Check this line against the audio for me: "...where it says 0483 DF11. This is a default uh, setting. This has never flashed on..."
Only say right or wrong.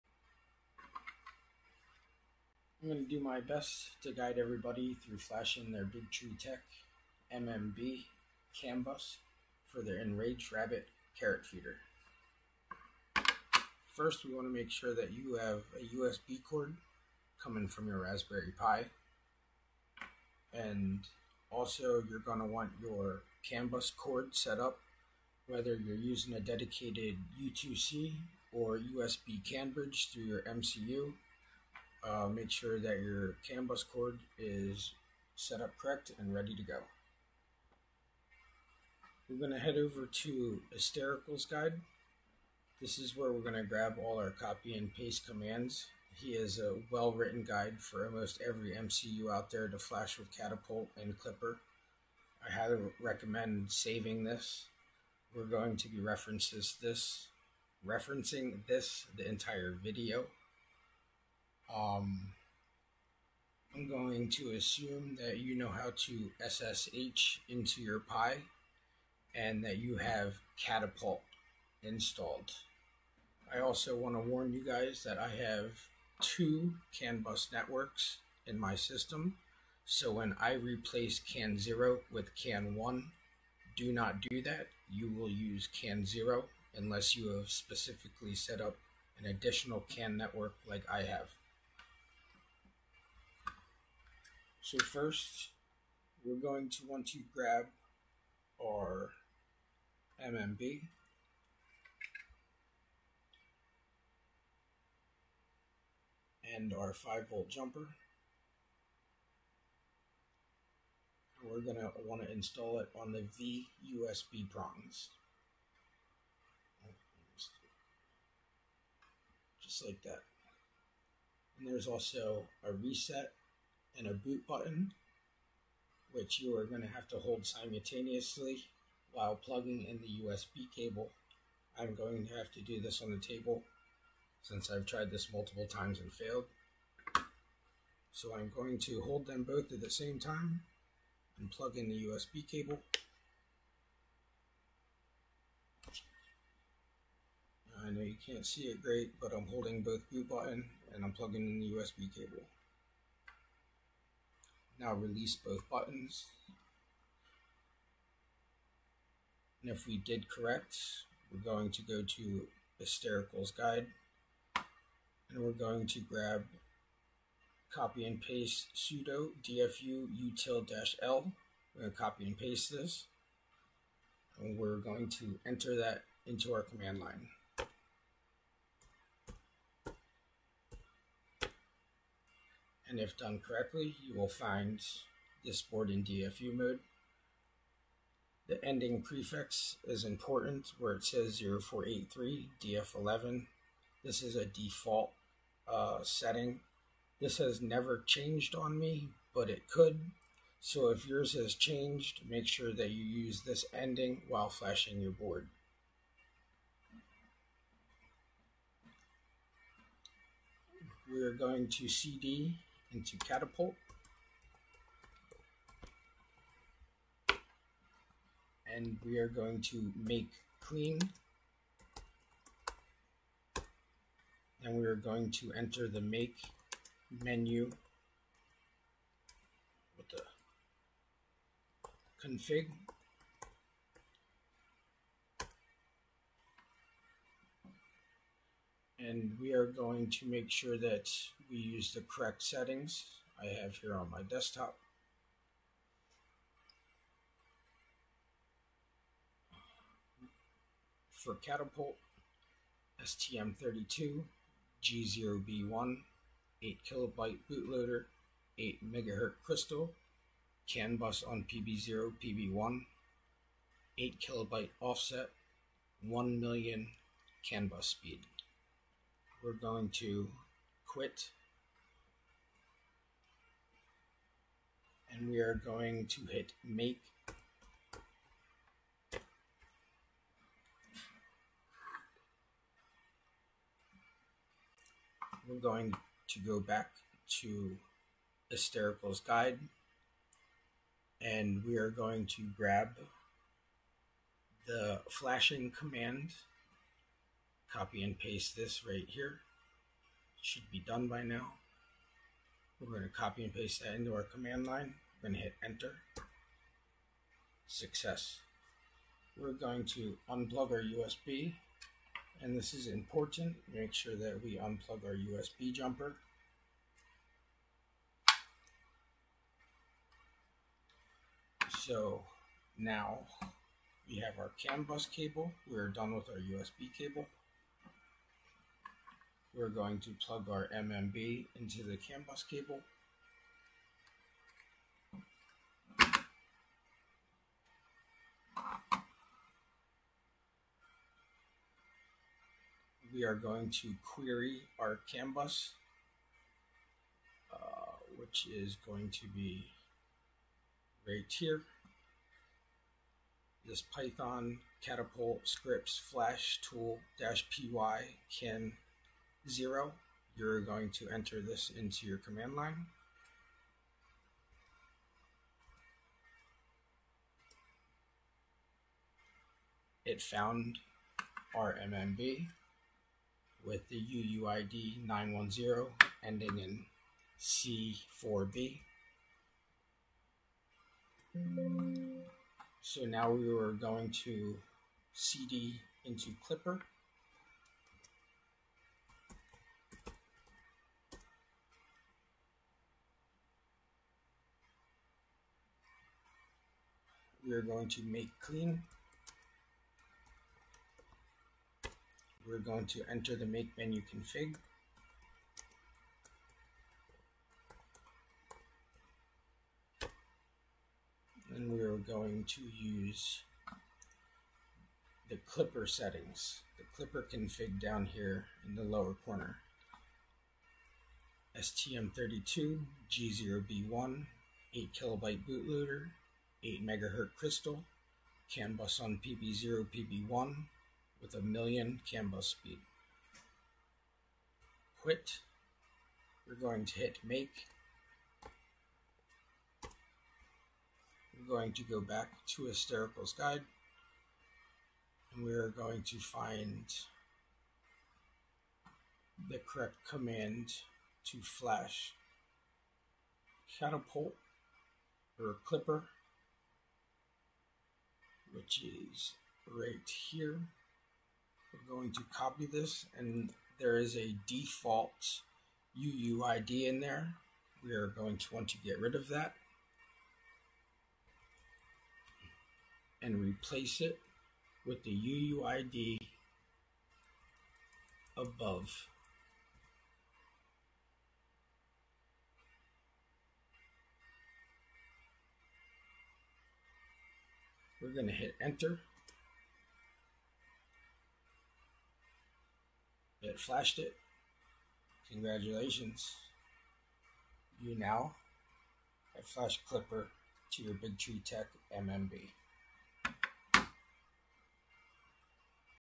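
wrong.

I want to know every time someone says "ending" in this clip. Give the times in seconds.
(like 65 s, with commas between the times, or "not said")
188 s, 203 s, 376 s.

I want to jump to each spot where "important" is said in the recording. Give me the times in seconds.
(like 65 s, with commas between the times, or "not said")
190 s, 312 s.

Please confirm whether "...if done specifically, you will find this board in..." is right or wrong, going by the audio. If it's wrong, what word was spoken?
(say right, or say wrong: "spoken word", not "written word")
wrong: "correctly", not "specifically".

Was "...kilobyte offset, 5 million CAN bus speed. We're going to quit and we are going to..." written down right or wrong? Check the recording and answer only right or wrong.
wrong.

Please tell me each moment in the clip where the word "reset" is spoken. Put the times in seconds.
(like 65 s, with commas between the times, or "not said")
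122 s.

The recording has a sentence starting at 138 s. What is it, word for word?
So I'm going to hold them both at the same time and plug in the USB cable.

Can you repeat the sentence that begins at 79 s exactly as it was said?
So when I replace CAN 0 with CAN 1, do not do that.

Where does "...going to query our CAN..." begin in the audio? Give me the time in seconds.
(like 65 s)
343 s.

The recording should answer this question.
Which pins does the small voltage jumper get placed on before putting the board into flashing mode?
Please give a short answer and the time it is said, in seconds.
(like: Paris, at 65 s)
V USB prongs, at 113 s.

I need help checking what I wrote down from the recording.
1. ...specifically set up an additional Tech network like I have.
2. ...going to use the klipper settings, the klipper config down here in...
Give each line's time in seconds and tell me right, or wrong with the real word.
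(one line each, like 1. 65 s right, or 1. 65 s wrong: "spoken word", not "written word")
1. 87 s wrong: "CAN", not "Tech"
2. 411 s right.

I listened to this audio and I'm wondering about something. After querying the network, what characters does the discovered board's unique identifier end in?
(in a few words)
C4B.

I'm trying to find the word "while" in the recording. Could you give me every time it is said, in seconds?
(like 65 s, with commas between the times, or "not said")
129 s, 204 s.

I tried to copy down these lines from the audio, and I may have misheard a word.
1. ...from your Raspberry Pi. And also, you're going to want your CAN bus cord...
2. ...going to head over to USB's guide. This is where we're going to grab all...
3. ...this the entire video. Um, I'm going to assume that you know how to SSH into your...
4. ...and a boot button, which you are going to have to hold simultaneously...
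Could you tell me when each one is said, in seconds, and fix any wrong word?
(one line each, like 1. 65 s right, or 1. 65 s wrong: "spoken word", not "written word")
1. 17 s right
2. 39 s wrong: "Esoterical", not "USB"
3. 58 s right
4. 123 s right.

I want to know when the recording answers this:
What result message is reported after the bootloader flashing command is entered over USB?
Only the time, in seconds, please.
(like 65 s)
307 s.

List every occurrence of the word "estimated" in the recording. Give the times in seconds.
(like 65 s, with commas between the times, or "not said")
not said.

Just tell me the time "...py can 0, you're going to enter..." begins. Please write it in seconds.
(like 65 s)
357 s.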